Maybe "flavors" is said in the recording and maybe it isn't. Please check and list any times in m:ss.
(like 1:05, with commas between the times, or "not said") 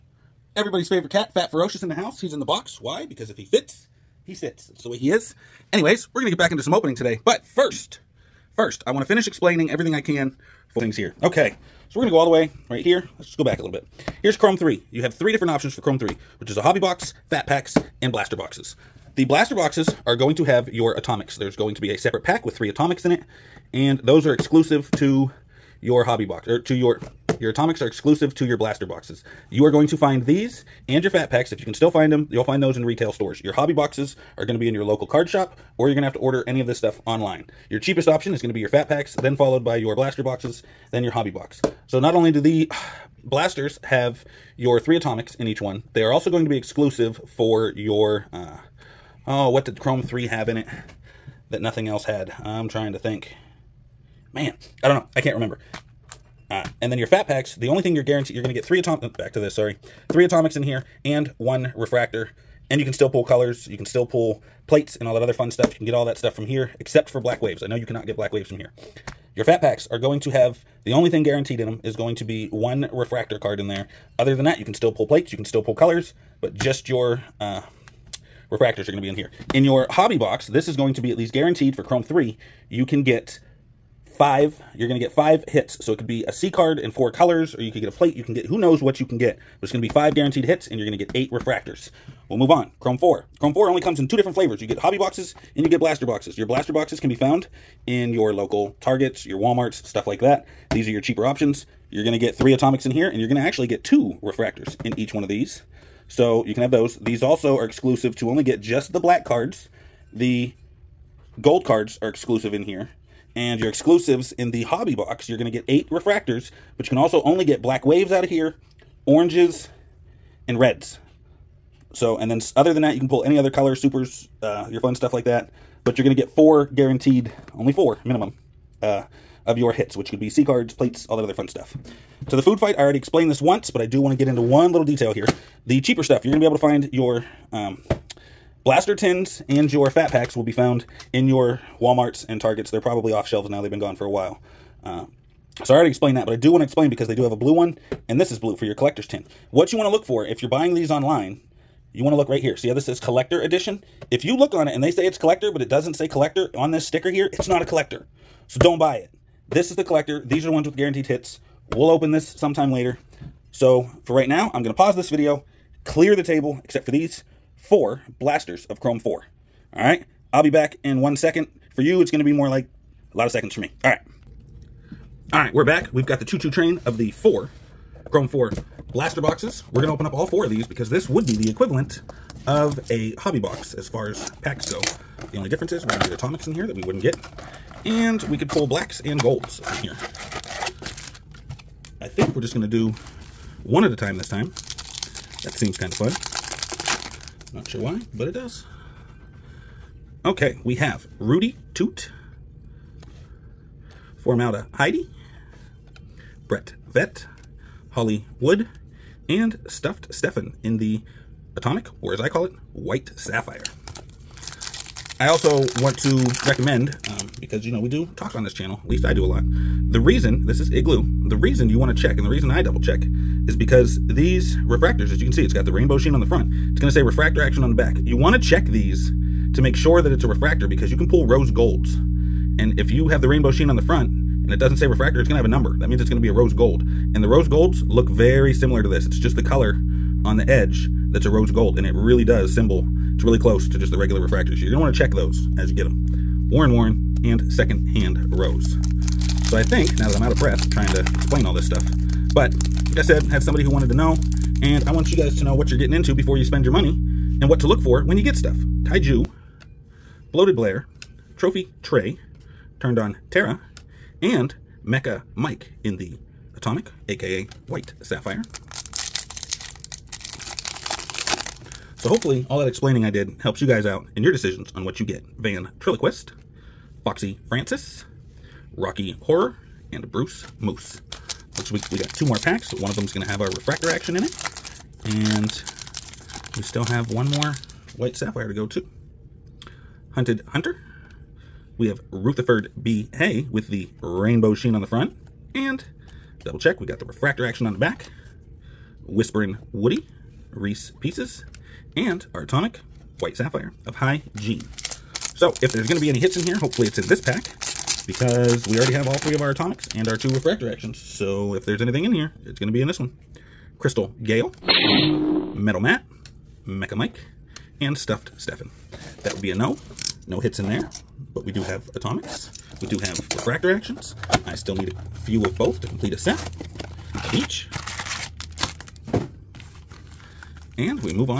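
1:34.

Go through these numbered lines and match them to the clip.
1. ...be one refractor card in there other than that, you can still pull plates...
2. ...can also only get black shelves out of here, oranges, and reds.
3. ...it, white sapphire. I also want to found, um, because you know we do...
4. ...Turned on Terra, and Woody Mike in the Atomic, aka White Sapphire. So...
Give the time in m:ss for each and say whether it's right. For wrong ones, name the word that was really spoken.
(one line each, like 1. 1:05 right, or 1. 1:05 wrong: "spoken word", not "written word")
1. 1:12 right
2. 1:56 wrong: "waves", not "shelves"
3. 3:32 wrong: "recommend", not "found"
4. 4:22 wrong: "Mecha", not "Woody".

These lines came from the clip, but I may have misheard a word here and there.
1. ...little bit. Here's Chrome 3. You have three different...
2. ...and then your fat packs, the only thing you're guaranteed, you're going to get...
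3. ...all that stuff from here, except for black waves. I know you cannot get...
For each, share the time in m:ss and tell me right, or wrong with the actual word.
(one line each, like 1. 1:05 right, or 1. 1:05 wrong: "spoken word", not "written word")
1. 0:13 right
2. 0:56 right
3. 1:05 right.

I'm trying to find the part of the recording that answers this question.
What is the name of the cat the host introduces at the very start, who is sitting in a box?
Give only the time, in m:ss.
0:01.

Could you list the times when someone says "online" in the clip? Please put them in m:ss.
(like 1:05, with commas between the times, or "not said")
0:37, 2:30.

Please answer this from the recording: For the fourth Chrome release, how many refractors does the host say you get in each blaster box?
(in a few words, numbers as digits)
2.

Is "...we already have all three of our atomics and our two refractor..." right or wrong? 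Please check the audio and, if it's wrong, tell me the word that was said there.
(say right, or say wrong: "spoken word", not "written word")
right.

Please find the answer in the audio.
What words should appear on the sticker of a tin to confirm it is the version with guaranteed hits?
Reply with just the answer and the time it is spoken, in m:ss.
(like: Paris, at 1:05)
Collector edition, at 2:32.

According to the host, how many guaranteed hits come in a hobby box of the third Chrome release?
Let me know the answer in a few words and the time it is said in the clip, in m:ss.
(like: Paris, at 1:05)
5, at 1:29.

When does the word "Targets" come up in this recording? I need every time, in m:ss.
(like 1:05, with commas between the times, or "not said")
1:38, 2:22.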